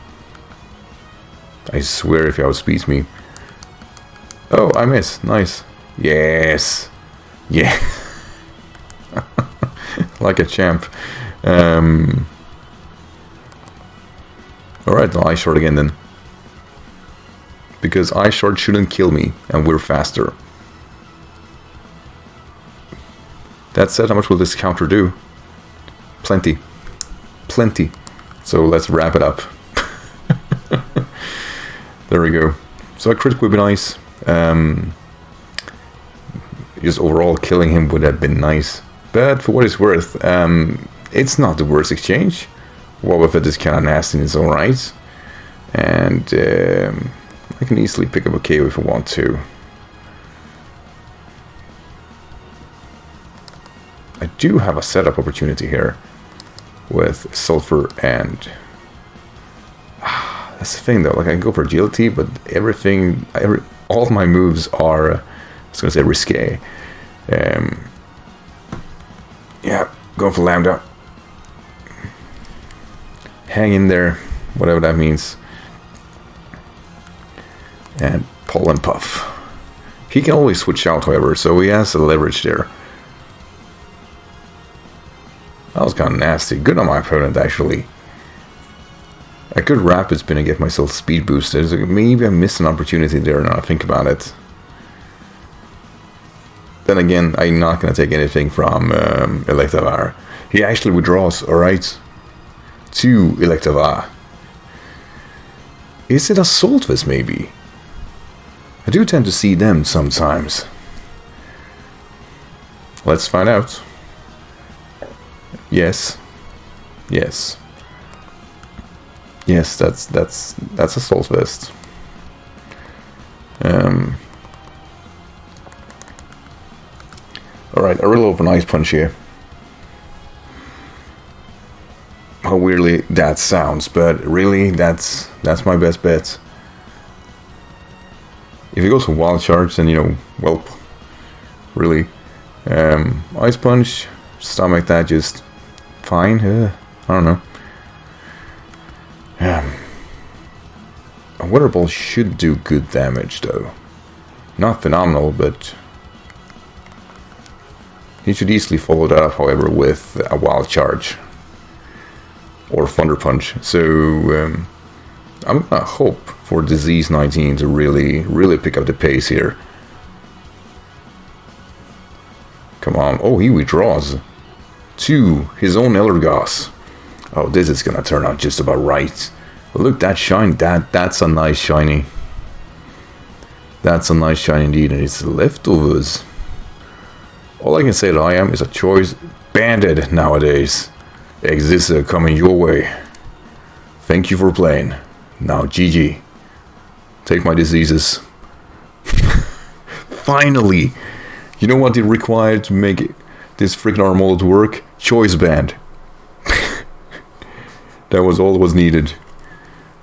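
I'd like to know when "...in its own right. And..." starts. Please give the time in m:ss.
0:44.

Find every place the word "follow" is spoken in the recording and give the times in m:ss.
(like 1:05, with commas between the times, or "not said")
2:38.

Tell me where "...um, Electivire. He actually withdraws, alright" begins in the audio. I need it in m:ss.
1:38.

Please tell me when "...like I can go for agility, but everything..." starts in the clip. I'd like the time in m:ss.
1:01.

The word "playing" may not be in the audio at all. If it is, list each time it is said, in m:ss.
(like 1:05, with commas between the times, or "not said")
3:14.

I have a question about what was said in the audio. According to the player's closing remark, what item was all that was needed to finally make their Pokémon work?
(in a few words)
Choice Band.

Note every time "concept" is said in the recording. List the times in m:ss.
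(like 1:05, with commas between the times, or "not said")
not said.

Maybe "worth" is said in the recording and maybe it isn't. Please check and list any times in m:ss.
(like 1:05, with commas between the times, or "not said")
0:39.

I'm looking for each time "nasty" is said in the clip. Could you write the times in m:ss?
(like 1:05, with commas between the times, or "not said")
0:43, 1:26.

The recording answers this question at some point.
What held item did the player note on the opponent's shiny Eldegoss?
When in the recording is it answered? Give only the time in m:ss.
3:05.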